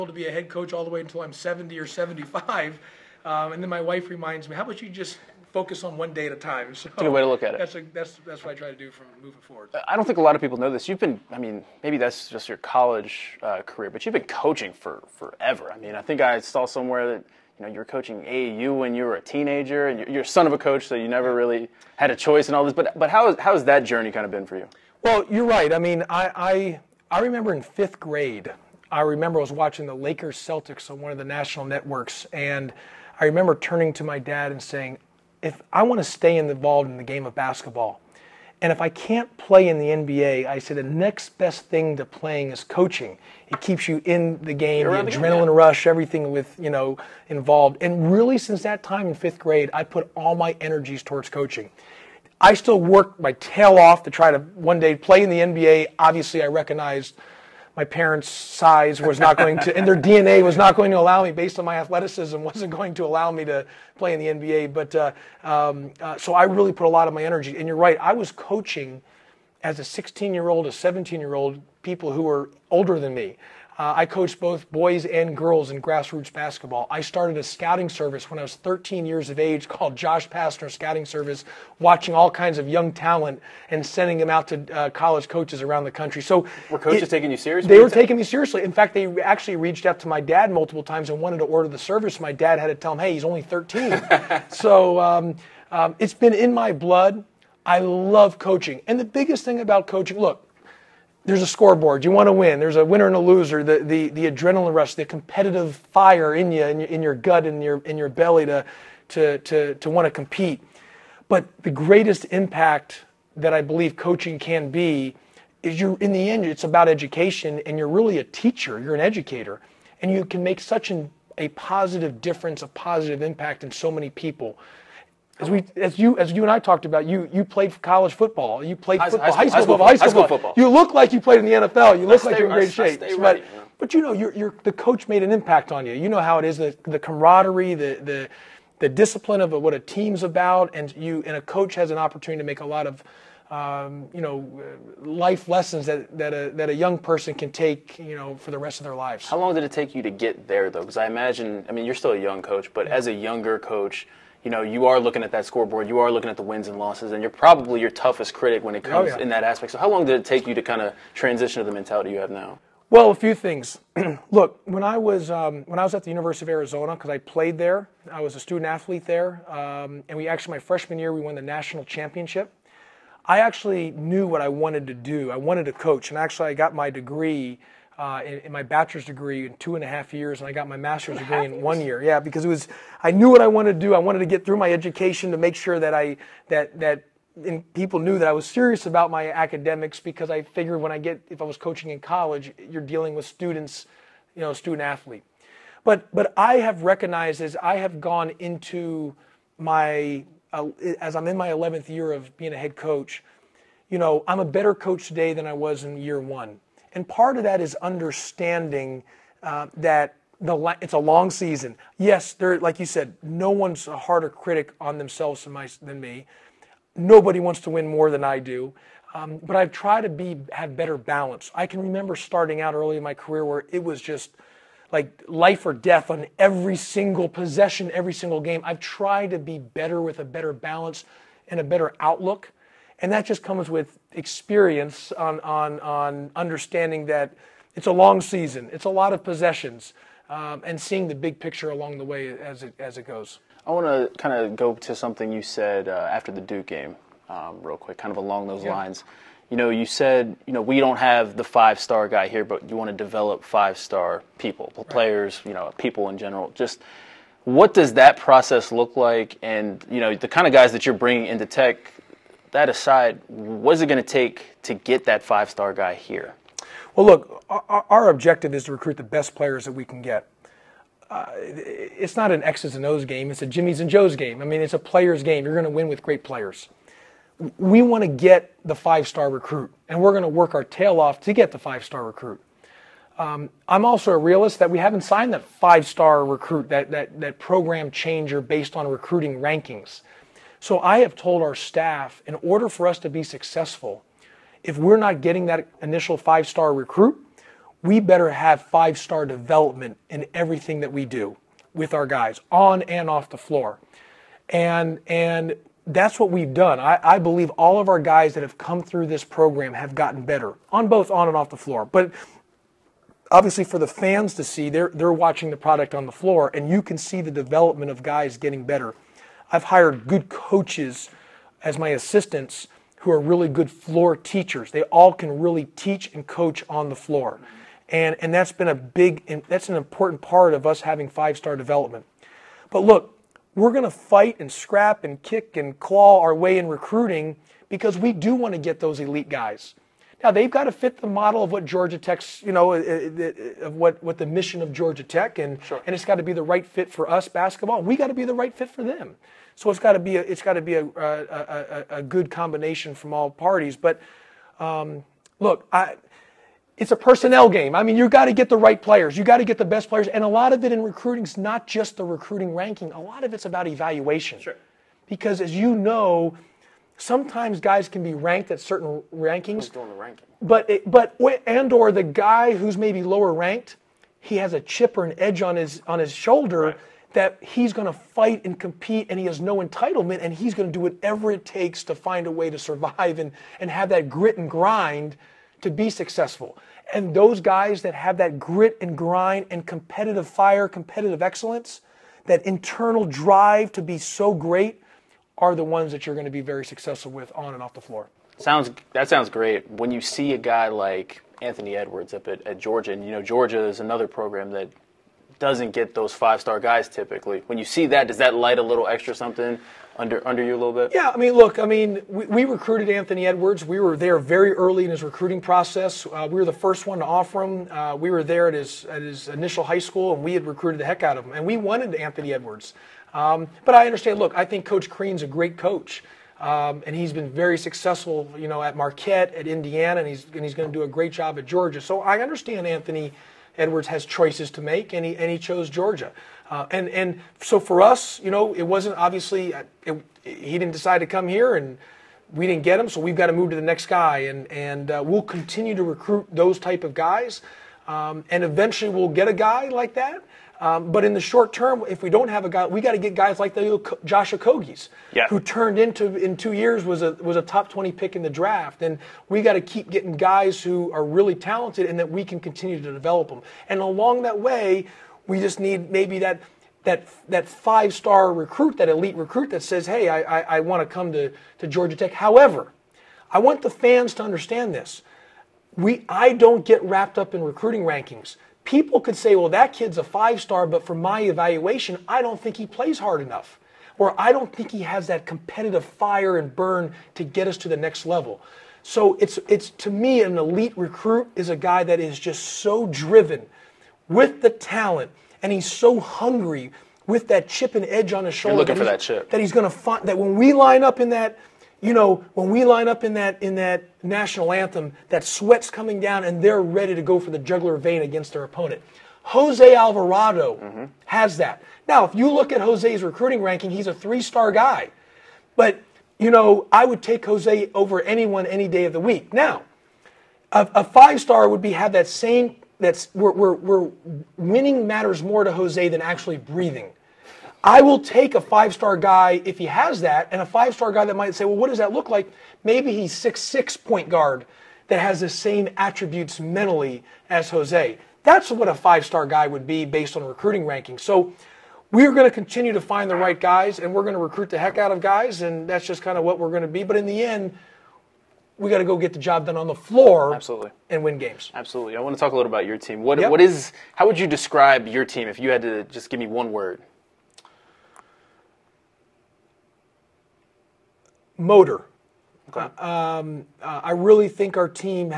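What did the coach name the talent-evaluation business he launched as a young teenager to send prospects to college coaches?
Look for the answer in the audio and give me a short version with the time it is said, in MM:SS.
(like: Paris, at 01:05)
Josh Pastner Scouting Service, at 01:19.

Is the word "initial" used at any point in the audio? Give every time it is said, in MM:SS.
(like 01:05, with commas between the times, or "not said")
04:55, 06:59.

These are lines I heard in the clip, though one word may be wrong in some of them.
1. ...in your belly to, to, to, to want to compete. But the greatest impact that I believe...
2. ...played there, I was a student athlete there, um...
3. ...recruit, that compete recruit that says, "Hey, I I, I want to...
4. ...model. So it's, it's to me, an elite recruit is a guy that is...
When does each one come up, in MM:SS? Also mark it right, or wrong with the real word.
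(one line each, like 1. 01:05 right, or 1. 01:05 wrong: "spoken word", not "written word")
1. 01:47 right
2. 02:47 right
3. 07:48 wrong: "elite", not "compete"
4. 08:08 wrong: "level", not "model".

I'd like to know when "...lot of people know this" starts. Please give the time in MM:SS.
00:10.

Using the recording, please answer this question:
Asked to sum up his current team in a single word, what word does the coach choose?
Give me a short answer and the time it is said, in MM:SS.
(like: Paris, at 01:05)
Motor, at 09:21.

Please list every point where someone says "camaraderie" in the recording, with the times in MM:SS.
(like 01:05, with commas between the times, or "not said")
02:16.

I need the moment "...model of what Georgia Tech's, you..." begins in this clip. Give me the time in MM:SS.
05:41.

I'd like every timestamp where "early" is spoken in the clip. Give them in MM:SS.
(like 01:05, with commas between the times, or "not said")
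03:42, 06:54.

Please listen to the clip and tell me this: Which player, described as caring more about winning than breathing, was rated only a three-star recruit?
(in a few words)
Jose Alvarado.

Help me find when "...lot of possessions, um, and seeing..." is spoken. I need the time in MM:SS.
03:58.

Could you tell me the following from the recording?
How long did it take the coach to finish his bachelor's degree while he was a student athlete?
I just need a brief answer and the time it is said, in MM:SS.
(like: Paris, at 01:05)
2.5 years, at 02:59.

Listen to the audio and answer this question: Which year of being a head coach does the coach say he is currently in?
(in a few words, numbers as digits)
11th.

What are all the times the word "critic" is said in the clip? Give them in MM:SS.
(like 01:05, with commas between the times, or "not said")
02:38, 03:34.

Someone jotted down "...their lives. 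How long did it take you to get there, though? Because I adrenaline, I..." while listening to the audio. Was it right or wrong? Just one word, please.
wrong.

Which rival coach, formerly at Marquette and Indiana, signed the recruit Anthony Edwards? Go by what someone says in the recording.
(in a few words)
Coach Crean.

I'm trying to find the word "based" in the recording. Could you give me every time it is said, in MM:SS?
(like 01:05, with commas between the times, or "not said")
01:01, 04:48, 08:59.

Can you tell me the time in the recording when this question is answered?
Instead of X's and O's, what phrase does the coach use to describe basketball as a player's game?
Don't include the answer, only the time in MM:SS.
04:33.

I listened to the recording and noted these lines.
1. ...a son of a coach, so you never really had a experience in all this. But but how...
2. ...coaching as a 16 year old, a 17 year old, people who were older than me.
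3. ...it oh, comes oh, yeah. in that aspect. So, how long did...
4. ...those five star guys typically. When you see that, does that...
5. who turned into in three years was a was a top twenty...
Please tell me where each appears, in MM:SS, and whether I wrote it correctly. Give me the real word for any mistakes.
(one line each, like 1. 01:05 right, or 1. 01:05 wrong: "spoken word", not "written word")
1. 00:20 wrong: "choice", not "experience"
2. 01:08 right
3. 02:38 right
4. 06:45 right
5. 07:35 wrong: "two", not "three".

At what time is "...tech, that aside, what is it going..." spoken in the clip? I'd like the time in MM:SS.
04:21.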